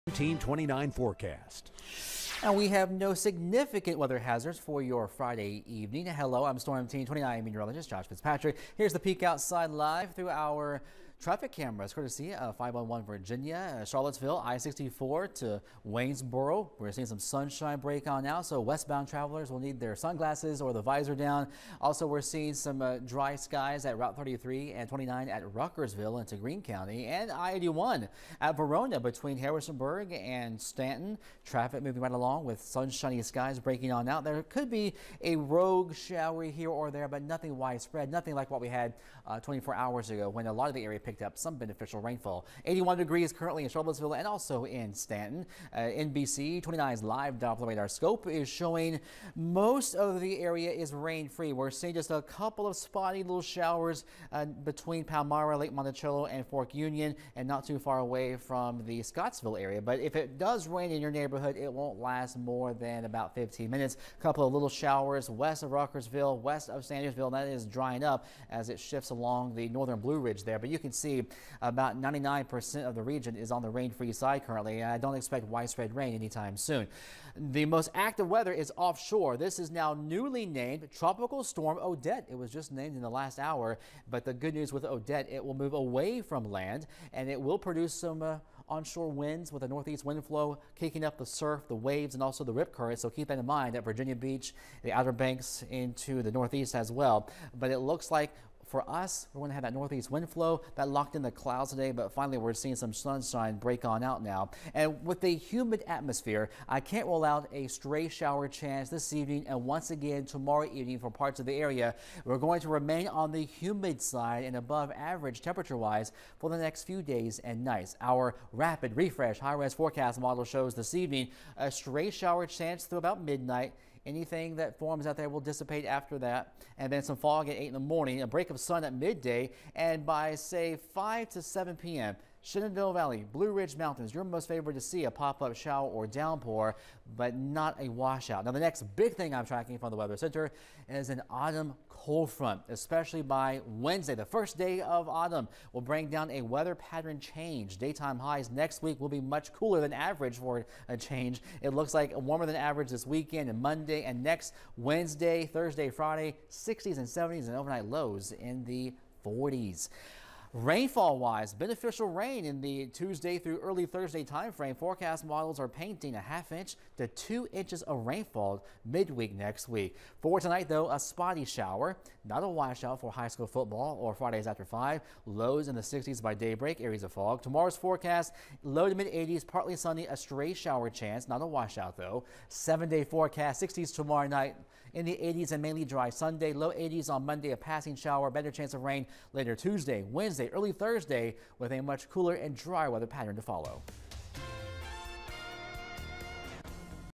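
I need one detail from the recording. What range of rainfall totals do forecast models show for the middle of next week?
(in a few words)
half inch to 2 inches.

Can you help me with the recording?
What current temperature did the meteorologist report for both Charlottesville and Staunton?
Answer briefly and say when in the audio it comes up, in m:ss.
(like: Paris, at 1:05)
81 degrees, at 0:42.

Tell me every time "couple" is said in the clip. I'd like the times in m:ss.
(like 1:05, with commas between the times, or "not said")
0:52, 1:04.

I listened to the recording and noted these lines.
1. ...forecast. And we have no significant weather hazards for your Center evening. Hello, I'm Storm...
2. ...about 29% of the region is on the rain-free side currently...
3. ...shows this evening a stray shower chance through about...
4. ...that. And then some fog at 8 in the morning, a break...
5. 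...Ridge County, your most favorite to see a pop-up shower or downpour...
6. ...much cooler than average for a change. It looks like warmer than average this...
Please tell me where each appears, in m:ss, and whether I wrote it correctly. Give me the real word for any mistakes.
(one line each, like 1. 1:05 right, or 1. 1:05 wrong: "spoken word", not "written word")
1. 0:00 wrong: "Friday", not "Center"
2. 1:11 wrong: "99", not "29"
3. 2:00 right
4. 2:06 right
5. 2:13 wrong: "Mountains", not "County"
6. 2:29 right.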